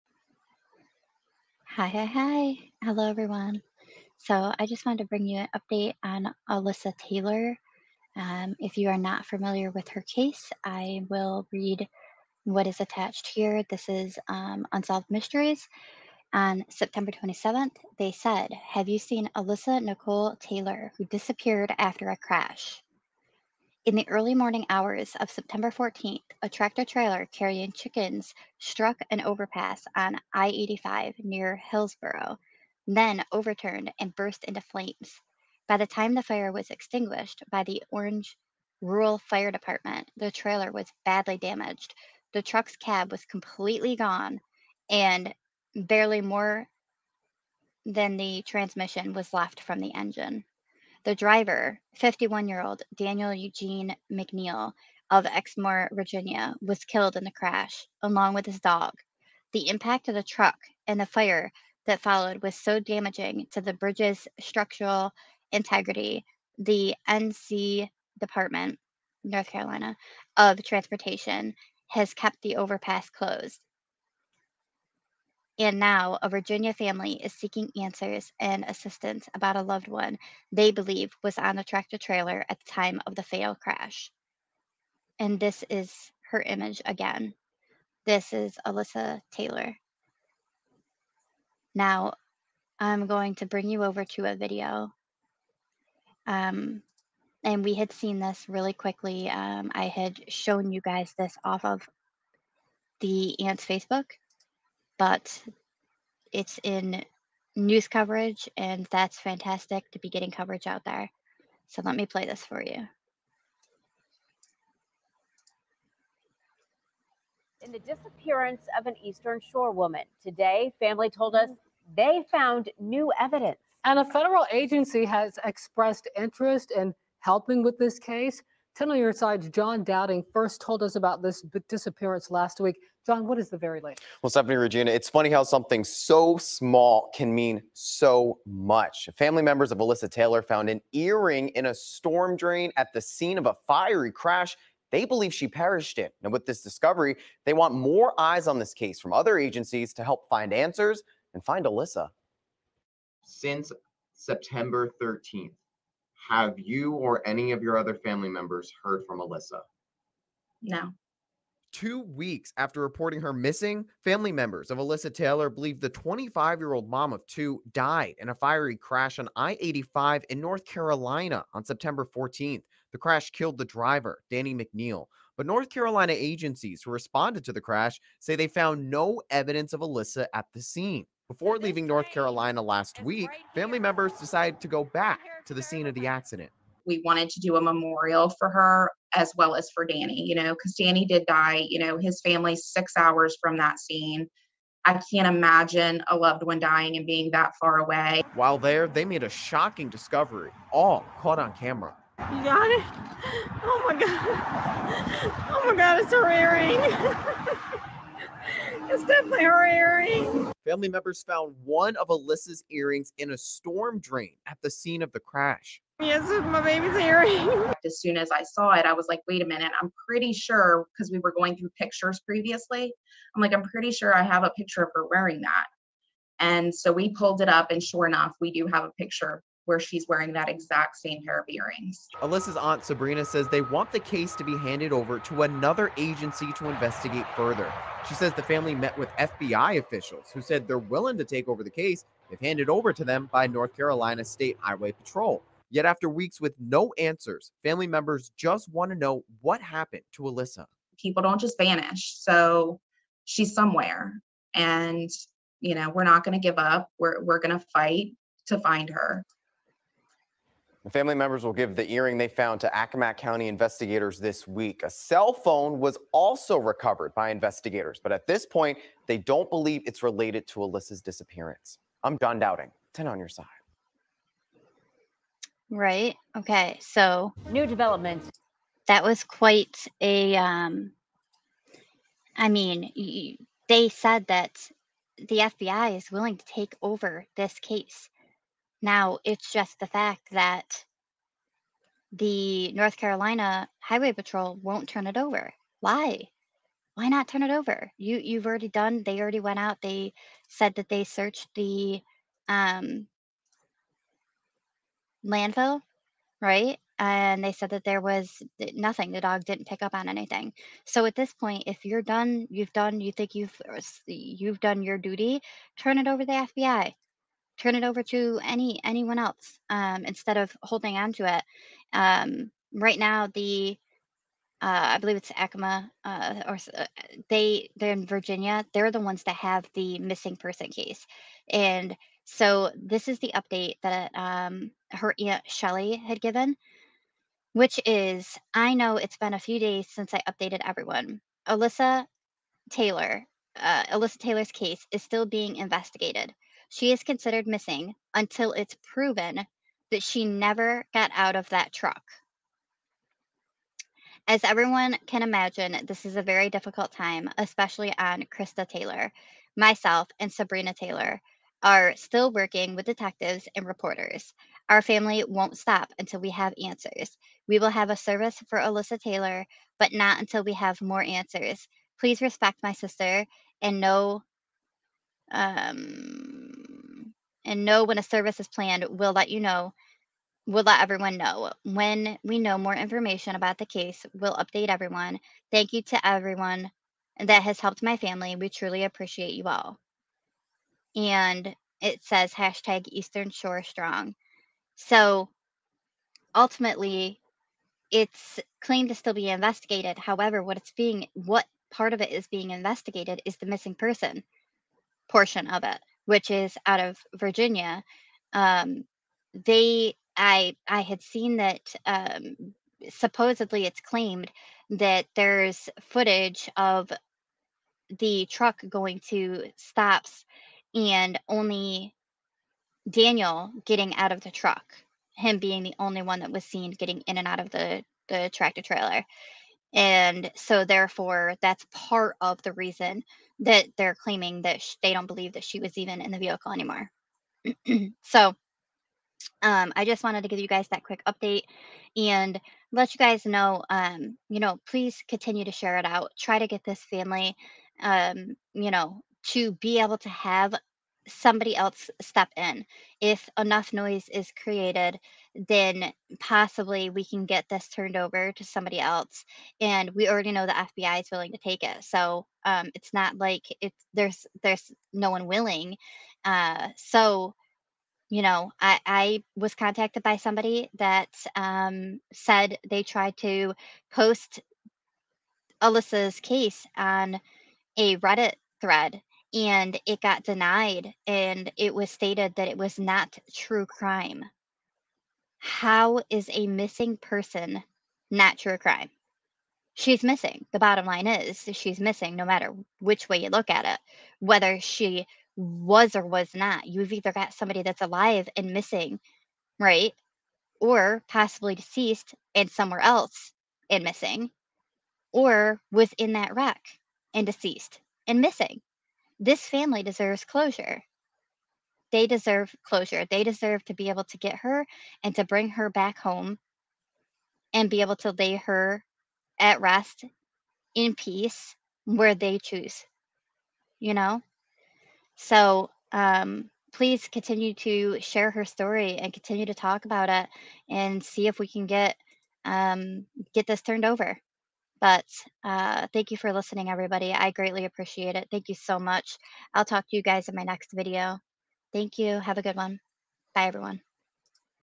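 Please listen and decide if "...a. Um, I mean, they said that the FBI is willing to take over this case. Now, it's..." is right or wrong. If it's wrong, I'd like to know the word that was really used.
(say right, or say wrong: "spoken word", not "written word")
right.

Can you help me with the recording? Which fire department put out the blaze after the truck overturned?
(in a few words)
Orange Rural Fire Department.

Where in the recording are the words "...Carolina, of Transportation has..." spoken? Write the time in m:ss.
1:09.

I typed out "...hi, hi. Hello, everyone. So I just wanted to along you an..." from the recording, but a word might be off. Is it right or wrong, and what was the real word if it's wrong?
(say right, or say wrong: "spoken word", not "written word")
wrong: "bring", not "along".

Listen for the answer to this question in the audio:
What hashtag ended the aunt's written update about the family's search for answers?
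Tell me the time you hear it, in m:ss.
6:32.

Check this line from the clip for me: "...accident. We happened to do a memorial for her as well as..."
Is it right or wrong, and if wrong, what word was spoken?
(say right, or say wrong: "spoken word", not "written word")
wrong: "wanted", not "happened".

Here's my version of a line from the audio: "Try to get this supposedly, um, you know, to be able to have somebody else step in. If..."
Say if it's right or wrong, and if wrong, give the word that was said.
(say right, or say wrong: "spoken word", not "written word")
wrong: "family", not "supposedly".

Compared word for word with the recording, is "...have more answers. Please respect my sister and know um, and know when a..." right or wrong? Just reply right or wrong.
right.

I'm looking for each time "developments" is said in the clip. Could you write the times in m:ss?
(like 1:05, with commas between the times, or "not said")
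4:37.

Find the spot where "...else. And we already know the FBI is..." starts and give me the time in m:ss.
7:38.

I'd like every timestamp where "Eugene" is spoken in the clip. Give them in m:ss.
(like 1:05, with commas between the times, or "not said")
0:53.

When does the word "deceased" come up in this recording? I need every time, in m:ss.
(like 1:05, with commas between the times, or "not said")
8:21, 8:27.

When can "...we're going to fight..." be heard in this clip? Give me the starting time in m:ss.
4:17.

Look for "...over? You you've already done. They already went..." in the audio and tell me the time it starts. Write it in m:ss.
4:57.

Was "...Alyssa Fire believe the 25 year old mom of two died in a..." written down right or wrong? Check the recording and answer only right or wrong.
wrong.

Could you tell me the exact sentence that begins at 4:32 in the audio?
I'm John Dowding, 10 on your side.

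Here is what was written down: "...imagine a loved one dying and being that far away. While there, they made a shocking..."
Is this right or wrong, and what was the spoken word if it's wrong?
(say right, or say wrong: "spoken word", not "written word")
right.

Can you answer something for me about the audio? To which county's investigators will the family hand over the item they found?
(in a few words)
Accomack County.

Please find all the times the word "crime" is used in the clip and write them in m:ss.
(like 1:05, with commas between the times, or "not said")
8:03, 8:08.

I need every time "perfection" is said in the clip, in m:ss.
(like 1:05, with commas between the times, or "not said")
not said.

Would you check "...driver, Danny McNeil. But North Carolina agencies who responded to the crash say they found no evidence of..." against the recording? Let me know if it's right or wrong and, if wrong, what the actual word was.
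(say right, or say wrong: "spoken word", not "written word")
right.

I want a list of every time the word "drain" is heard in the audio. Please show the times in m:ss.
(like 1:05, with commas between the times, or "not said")
2:22, 3:34.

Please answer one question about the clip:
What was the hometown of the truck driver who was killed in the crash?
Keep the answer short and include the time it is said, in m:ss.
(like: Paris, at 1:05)
Exmore, Virginia, at 0:55.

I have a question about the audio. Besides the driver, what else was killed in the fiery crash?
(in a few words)
His dog.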